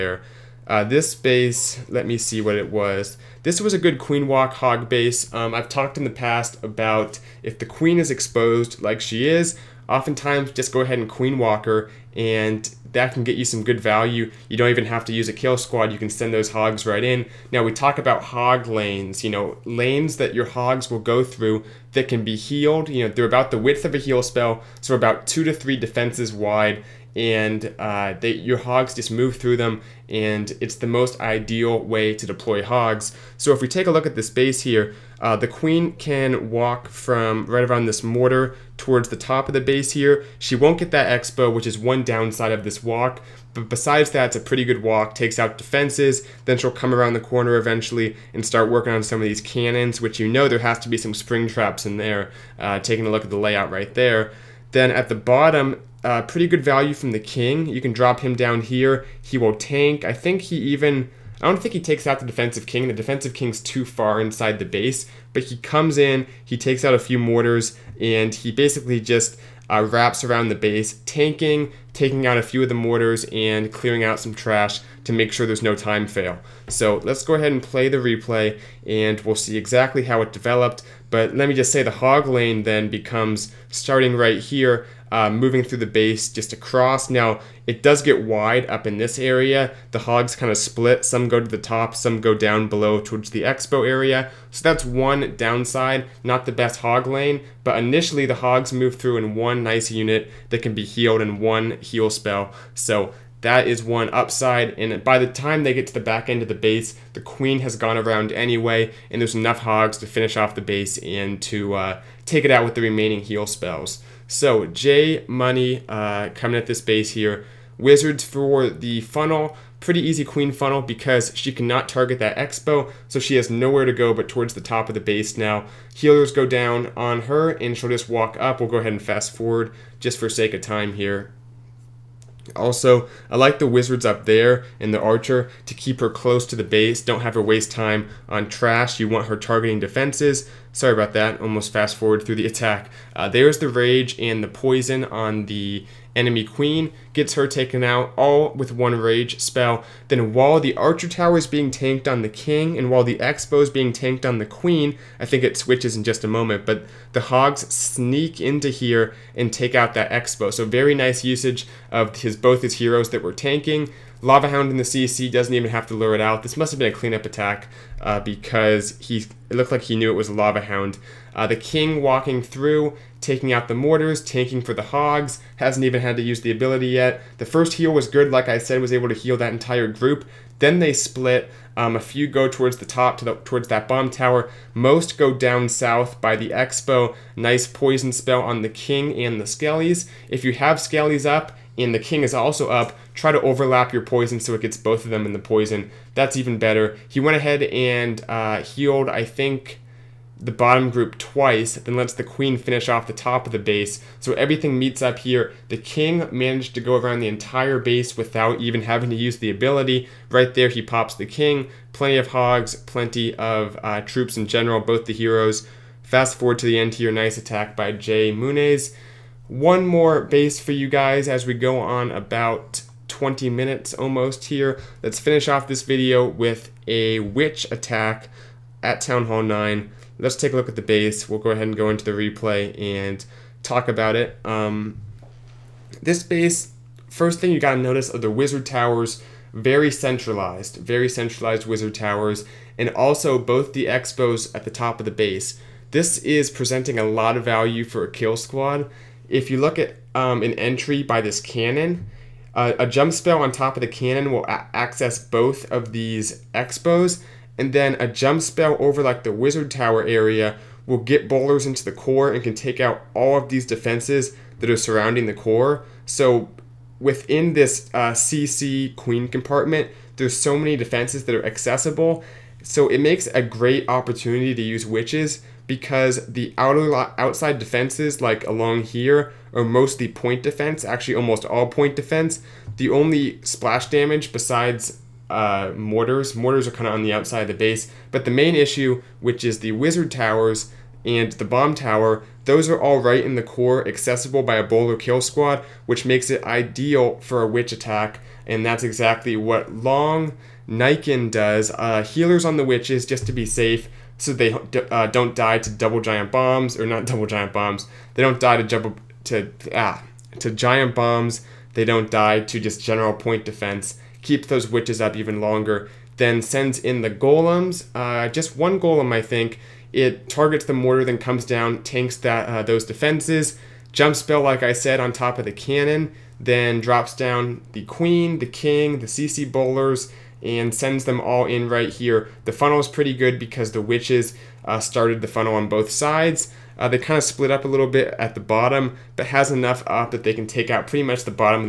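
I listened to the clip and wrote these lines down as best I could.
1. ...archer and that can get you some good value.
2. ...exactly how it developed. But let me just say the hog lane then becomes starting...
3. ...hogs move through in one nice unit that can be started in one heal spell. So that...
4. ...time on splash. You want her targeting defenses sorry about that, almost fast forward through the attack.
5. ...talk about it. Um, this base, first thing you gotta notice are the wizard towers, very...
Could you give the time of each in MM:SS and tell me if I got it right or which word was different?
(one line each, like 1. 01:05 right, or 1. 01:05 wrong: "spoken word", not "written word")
1. 00:11 wrong: "walker", not "archer"
2. 01:19 right
3. 01:38 wrong: "healed", not "started"
4. 02:17 wrong: "trash", not "splash"
5. 03:53 right.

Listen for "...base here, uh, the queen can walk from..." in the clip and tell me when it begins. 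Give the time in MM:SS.
00:34.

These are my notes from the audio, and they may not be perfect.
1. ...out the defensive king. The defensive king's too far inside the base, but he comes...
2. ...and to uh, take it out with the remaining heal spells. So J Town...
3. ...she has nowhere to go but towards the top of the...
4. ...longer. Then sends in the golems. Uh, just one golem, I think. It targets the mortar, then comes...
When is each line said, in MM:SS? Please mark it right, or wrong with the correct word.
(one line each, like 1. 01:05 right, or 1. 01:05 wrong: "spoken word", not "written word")
1. 01:02 right
2. 01:50 wrong: "Money", not "Town"
3. 02:03 right
4. 05:15 right.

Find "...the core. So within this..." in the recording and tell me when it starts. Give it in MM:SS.
04:25.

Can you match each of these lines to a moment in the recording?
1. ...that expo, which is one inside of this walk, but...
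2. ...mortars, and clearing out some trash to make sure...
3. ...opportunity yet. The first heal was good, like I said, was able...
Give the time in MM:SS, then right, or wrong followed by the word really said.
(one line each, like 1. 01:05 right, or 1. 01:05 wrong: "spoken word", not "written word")
1. 00:40 wrong: "downside", not "inside"
2. 01:12 right
3. 02:56 wrong: "ability", not "opportunity".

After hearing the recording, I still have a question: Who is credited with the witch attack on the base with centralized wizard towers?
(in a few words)
Long Nikon.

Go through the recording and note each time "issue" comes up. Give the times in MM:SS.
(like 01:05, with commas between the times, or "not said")
04:48.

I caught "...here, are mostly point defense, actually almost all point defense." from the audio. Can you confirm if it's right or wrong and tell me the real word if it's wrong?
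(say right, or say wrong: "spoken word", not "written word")
right.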